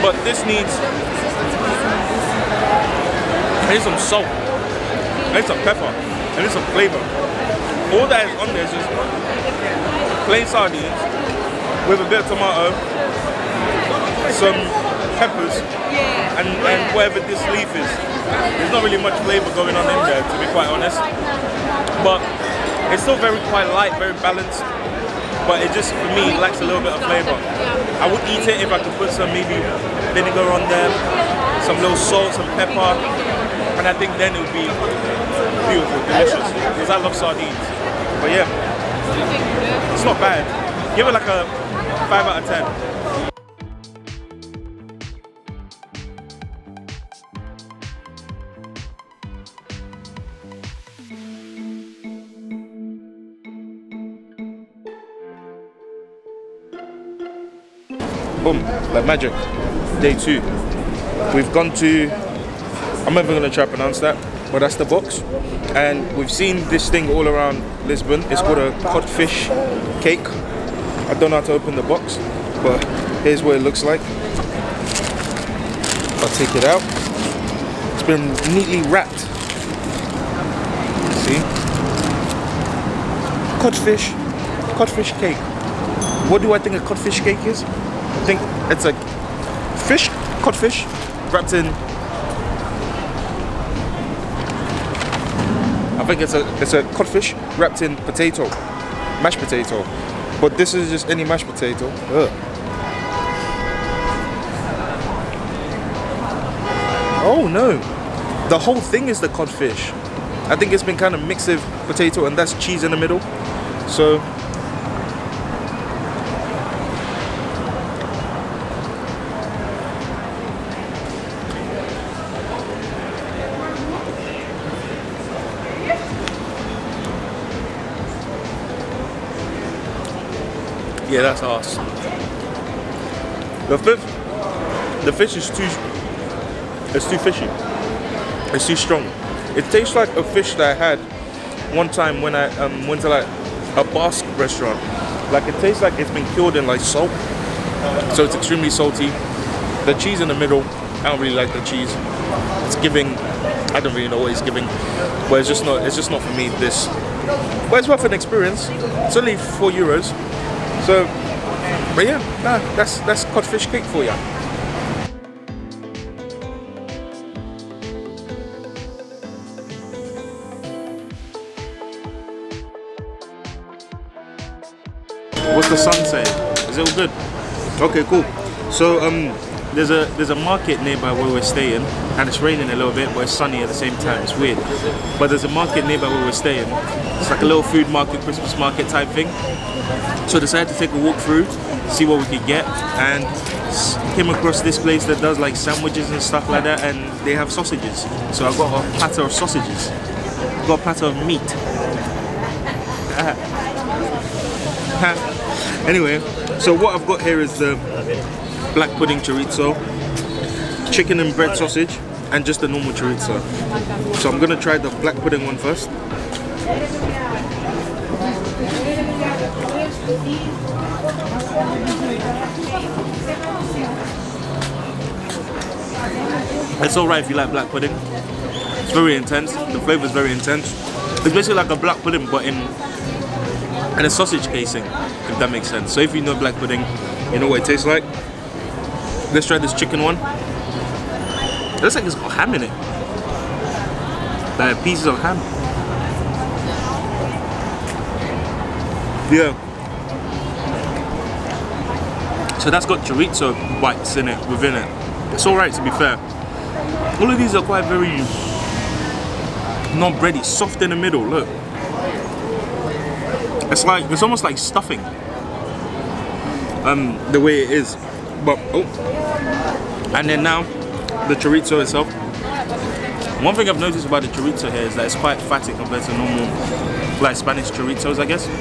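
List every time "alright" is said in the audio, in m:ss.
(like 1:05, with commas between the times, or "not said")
3:46, 4:15.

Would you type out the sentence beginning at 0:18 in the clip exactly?
There's not really much flavor going on in there, to be quite honest.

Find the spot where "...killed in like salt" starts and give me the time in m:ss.
2:26.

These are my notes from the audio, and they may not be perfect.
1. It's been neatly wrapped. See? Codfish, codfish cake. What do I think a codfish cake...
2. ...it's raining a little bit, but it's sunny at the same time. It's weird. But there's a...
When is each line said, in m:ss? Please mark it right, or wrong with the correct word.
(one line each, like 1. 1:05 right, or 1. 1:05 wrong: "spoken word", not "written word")
1. 1:17 right
2. 3:02 right.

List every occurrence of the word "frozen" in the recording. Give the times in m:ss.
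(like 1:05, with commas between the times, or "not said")
not said.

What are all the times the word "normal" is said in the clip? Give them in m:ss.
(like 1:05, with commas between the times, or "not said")
3:32, 4:36.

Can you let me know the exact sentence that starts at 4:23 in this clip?
It's like, it's almost like stuffing.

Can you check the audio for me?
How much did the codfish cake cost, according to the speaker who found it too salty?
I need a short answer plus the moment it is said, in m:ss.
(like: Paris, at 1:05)
4 euros, at 2:39.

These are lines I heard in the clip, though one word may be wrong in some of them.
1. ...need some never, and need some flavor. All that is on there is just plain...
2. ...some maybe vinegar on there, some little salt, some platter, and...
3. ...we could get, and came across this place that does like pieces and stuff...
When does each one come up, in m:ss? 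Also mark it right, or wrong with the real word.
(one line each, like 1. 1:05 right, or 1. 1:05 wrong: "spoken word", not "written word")
1. 0:05 wrong: "pepper", not "never"
2. 0:29 wrong: "pepper", not "platter"
3. 3:12 wrong: "sandwiches", not "pieces".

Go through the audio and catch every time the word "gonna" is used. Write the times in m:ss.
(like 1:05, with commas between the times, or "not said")
1:03, 3:34.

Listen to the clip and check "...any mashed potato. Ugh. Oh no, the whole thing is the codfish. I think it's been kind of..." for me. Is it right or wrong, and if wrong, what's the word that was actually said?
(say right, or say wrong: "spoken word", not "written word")
right.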